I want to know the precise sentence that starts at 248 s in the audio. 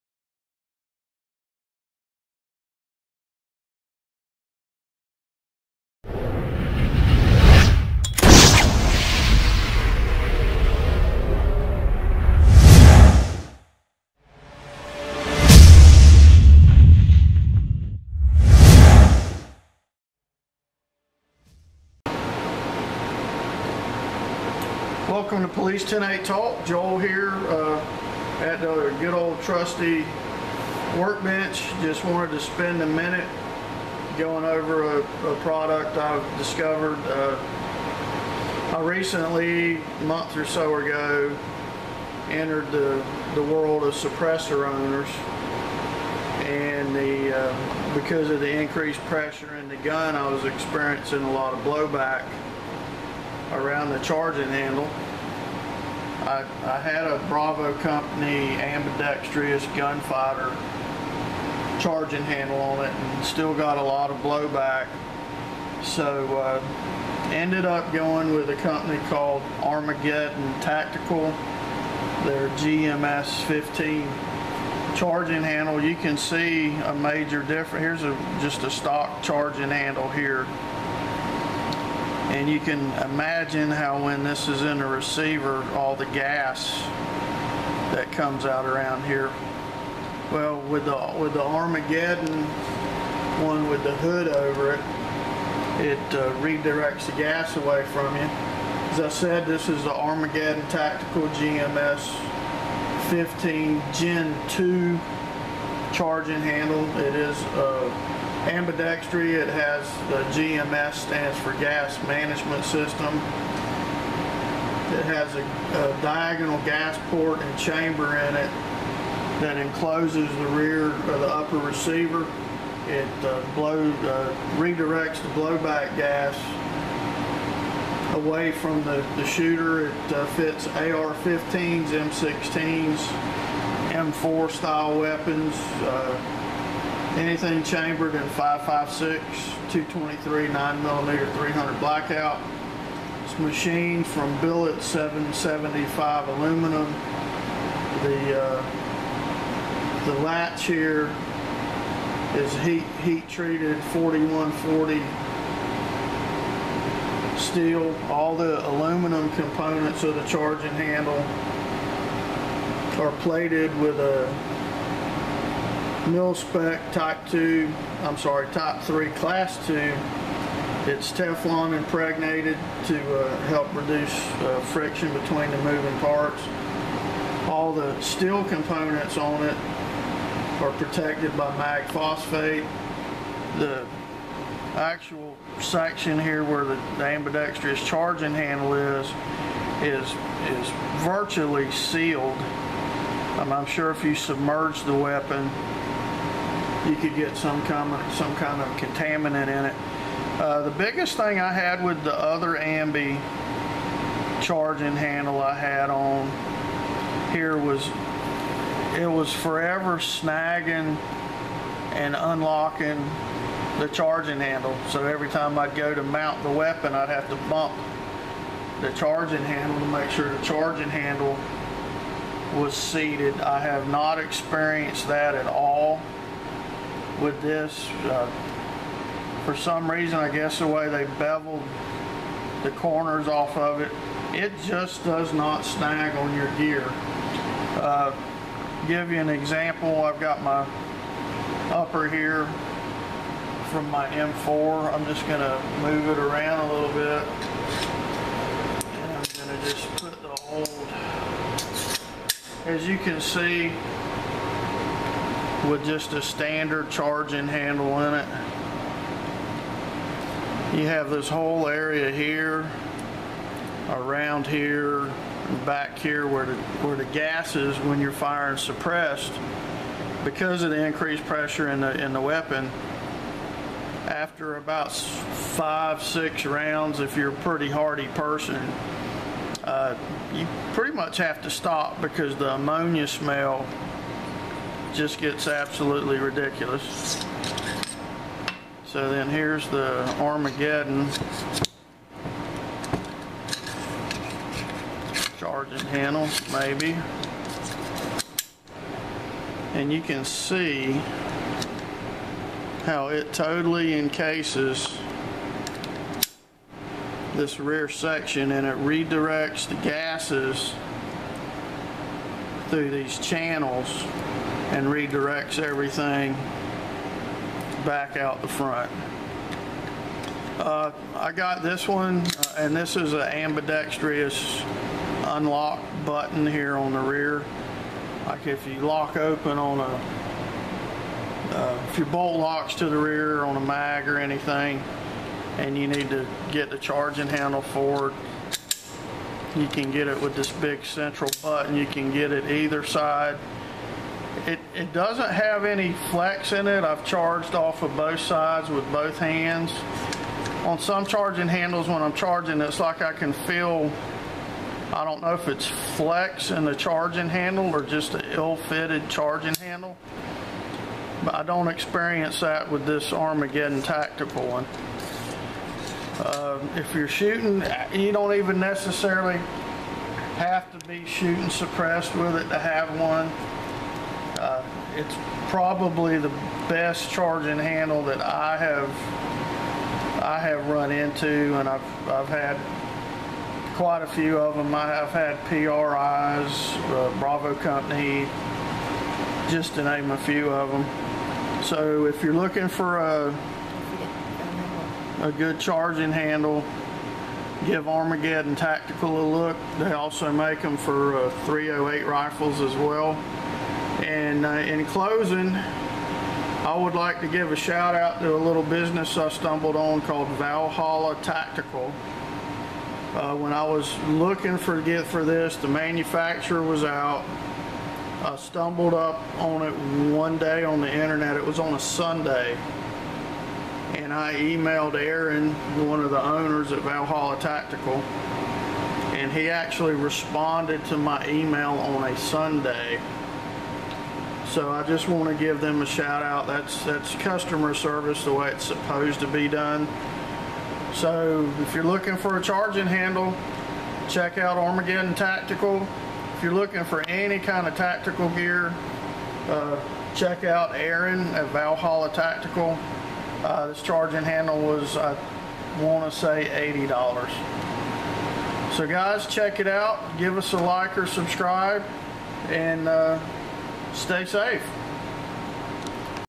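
And I'm going to just put the old, as you can see, with just a standard charging handle in it.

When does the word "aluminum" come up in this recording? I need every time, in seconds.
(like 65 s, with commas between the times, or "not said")
146 s, 158 s.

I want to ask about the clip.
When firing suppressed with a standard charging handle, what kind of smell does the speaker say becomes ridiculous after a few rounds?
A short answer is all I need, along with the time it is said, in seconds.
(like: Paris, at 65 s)
Ammonia, at 282 s.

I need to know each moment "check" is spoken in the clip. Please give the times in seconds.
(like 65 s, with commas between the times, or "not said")
444 s, 450 s, 459 s.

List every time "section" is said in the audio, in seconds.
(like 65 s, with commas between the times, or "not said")
185 s, 307 s.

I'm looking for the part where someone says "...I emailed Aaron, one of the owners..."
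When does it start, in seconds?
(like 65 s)
424 s.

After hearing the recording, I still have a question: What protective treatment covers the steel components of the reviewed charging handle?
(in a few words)
Mag phosphate.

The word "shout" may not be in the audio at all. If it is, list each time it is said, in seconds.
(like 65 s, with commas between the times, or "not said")
407 s, 435 s.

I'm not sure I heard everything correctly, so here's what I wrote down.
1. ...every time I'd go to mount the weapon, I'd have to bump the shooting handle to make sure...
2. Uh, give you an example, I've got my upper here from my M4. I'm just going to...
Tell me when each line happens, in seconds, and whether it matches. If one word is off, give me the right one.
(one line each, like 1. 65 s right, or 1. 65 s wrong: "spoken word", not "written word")
1. 215 s wrong: "charging", not "shooting"
2. 237 s right.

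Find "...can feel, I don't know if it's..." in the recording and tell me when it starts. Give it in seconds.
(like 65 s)
353 s.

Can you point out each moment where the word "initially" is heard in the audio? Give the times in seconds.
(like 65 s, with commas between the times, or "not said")
not said.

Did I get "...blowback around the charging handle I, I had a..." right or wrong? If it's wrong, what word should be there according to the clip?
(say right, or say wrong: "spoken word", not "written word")
right.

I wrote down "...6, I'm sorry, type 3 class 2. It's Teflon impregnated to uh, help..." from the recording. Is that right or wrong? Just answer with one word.
wrong.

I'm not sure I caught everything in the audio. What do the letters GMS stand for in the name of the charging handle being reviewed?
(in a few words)
Gas management system.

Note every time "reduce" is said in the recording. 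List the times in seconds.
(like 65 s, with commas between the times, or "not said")
173 s.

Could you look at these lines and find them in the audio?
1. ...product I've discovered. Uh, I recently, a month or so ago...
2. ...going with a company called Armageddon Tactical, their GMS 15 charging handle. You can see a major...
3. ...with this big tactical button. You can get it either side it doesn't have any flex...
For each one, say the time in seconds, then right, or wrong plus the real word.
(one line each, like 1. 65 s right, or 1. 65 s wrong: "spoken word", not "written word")
1. 35 s right
2. 67 s right
3. 340 s wrong: "central", not "tactical".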